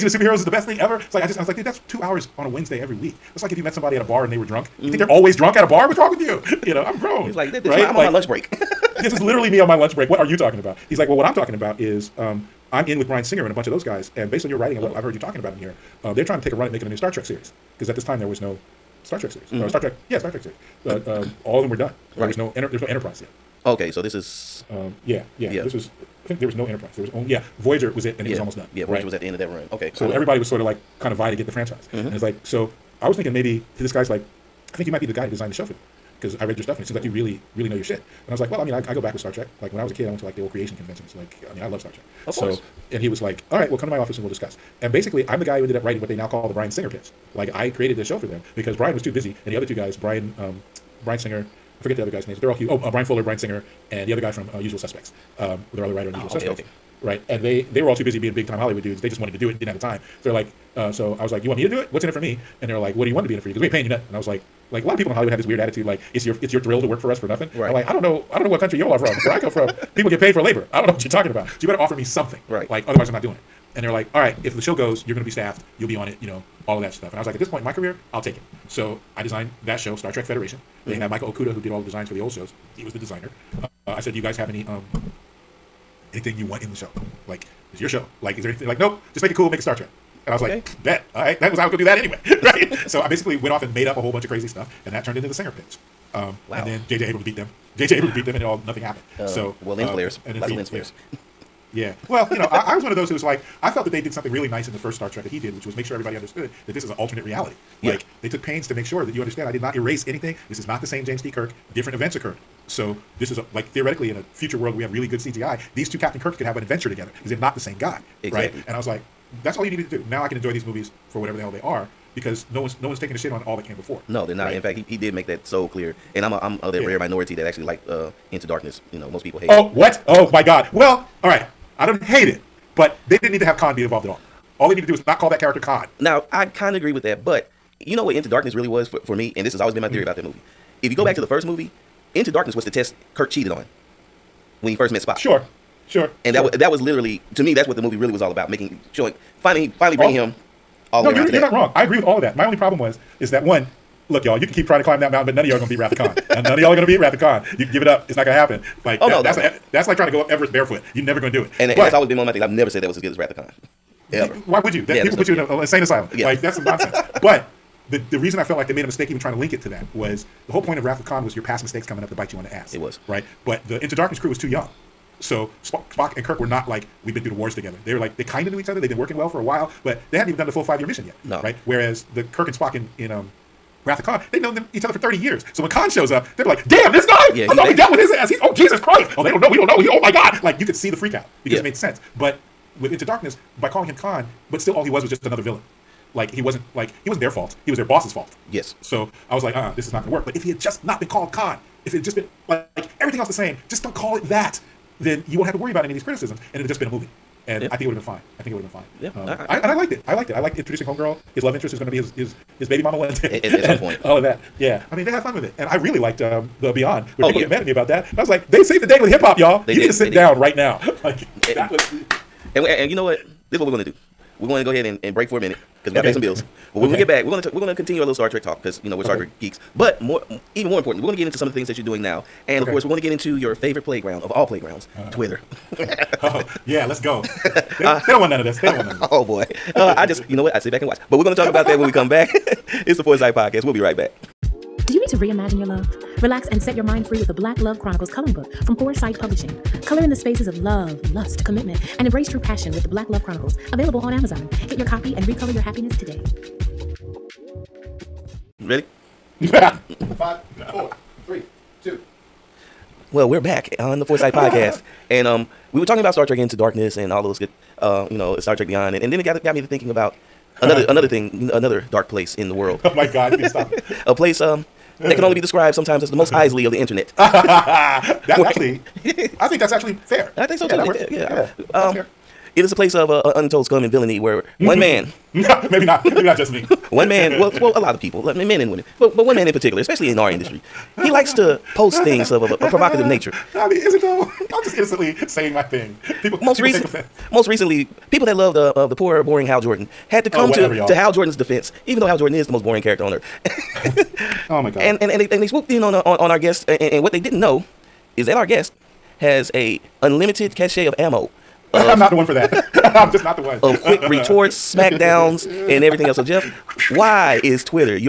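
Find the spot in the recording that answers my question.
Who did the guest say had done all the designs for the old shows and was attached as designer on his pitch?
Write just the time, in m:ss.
1:21.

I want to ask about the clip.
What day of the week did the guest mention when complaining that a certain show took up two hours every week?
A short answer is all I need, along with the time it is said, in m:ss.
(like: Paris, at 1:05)
Wednesday, at 0:02.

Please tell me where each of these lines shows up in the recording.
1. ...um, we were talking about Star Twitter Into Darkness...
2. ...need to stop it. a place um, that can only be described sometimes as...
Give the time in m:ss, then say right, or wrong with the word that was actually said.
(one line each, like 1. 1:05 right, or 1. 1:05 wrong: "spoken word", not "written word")
1. 4:25 wrong: "Trek", not "Twitter"
2. 4:33 right.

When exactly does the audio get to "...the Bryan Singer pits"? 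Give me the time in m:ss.
0:46.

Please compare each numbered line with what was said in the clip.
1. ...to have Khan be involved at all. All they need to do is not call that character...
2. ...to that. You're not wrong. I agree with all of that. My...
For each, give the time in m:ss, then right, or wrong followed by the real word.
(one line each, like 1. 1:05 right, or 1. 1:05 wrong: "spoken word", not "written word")
1. 2:13 right
2. 2:31 right.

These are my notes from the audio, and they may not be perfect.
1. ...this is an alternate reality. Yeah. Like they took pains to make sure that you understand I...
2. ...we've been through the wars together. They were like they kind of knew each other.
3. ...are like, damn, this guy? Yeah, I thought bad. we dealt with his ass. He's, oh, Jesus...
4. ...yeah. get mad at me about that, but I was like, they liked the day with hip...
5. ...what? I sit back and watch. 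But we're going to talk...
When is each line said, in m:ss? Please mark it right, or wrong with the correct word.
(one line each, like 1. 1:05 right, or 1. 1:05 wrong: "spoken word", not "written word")
1. 1:46 right
2. 2:57 right
3. 3:06 right
4. 3:37 wrong: "saved", not "liked"
5. 4:00 right.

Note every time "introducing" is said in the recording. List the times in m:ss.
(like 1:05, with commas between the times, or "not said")
3:30.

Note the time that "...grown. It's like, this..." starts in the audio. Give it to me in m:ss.
0:06.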